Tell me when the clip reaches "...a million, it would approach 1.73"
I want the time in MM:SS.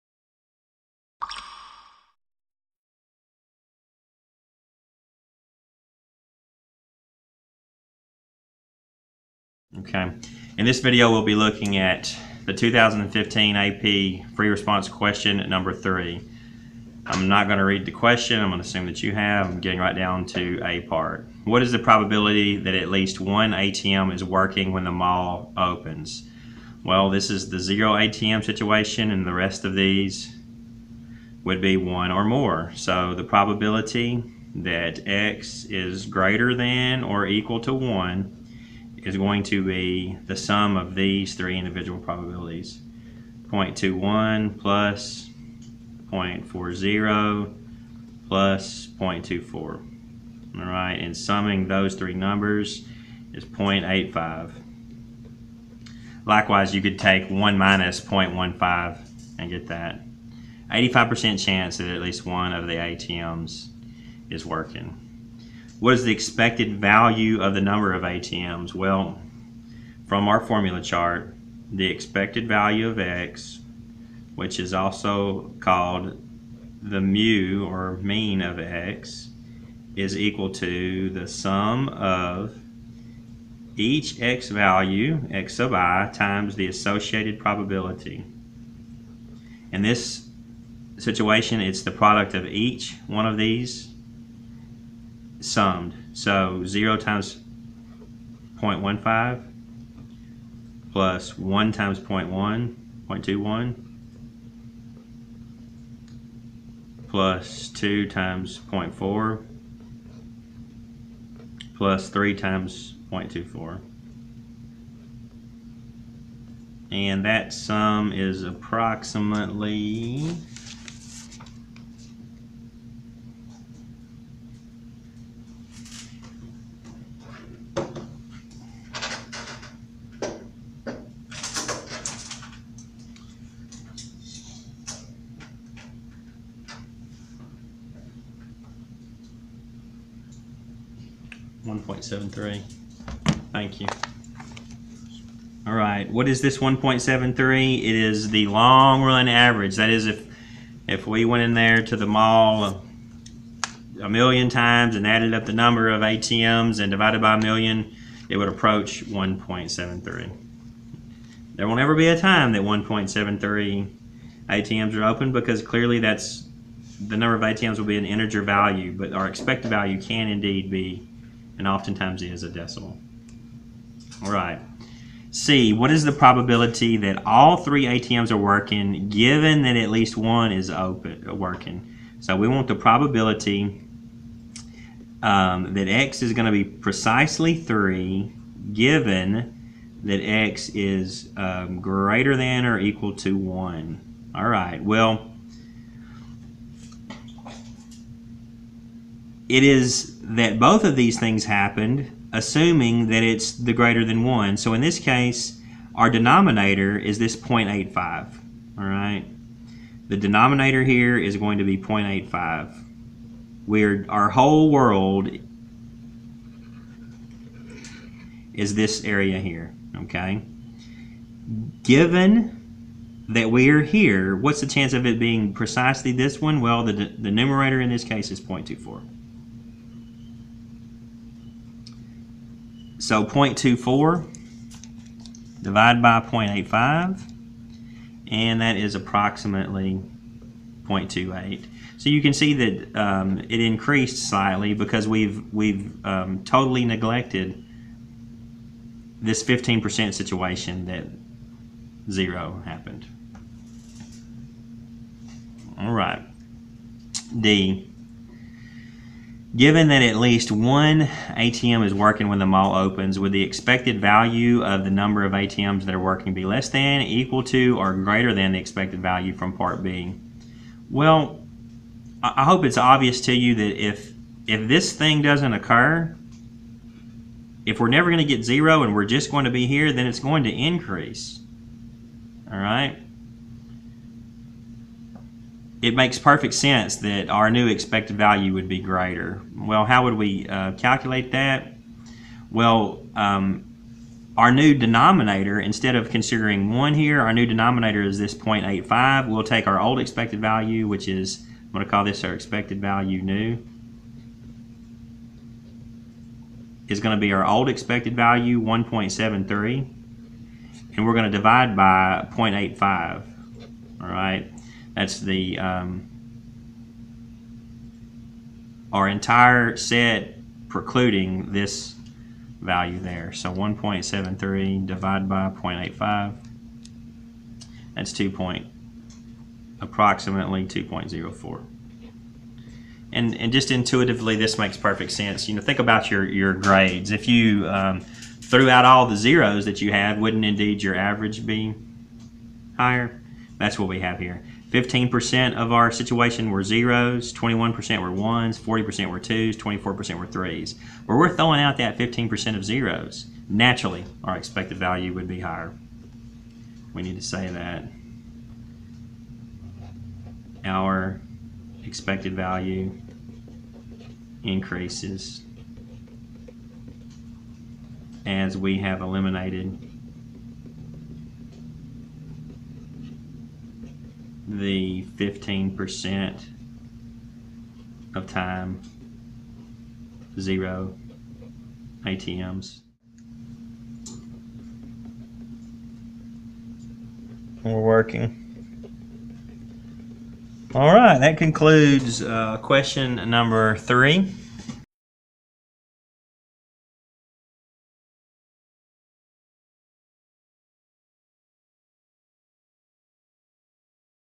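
02:37.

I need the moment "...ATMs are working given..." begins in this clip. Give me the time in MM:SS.
02:57.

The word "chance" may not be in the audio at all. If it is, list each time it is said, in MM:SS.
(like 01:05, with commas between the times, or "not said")
01:01, 03:44.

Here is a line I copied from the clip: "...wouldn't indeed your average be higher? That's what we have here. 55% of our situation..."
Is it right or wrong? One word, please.
wrong.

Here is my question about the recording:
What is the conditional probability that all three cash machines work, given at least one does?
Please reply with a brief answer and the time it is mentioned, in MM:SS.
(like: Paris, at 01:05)
0.28, at 04:00.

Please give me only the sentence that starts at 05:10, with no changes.
And we're going to divide by 0.85.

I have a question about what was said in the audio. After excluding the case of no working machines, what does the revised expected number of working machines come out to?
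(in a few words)
2.04.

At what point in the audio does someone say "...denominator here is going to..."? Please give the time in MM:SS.
03:30.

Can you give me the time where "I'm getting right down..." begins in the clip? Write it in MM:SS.
00:19.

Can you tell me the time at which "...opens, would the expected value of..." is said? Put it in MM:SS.
04:22.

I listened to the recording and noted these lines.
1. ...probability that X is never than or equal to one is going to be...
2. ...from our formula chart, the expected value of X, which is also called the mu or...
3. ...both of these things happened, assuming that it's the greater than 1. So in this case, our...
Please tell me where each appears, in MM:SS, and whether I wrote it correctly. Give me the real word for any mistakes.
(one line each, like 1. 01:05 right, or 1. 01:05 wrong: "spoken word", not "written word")
1. 00:33 wrong: "greater", not "never"
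2. 01:10 right
3. 03:20 right.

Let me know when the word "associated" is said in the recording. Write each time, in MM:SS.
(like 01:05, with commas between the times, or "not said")
01:26.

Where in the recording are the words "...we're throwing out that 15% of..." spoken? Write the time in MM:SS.
05:51.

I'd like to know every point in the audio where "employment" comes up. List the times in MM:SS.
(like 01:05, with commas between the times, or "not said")
not said.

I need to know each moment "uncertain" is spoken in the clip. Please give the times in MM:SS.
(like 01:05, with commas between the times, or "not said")
not said.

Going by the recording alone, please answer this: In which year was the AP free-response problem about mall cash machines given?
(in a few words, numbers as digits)
2015.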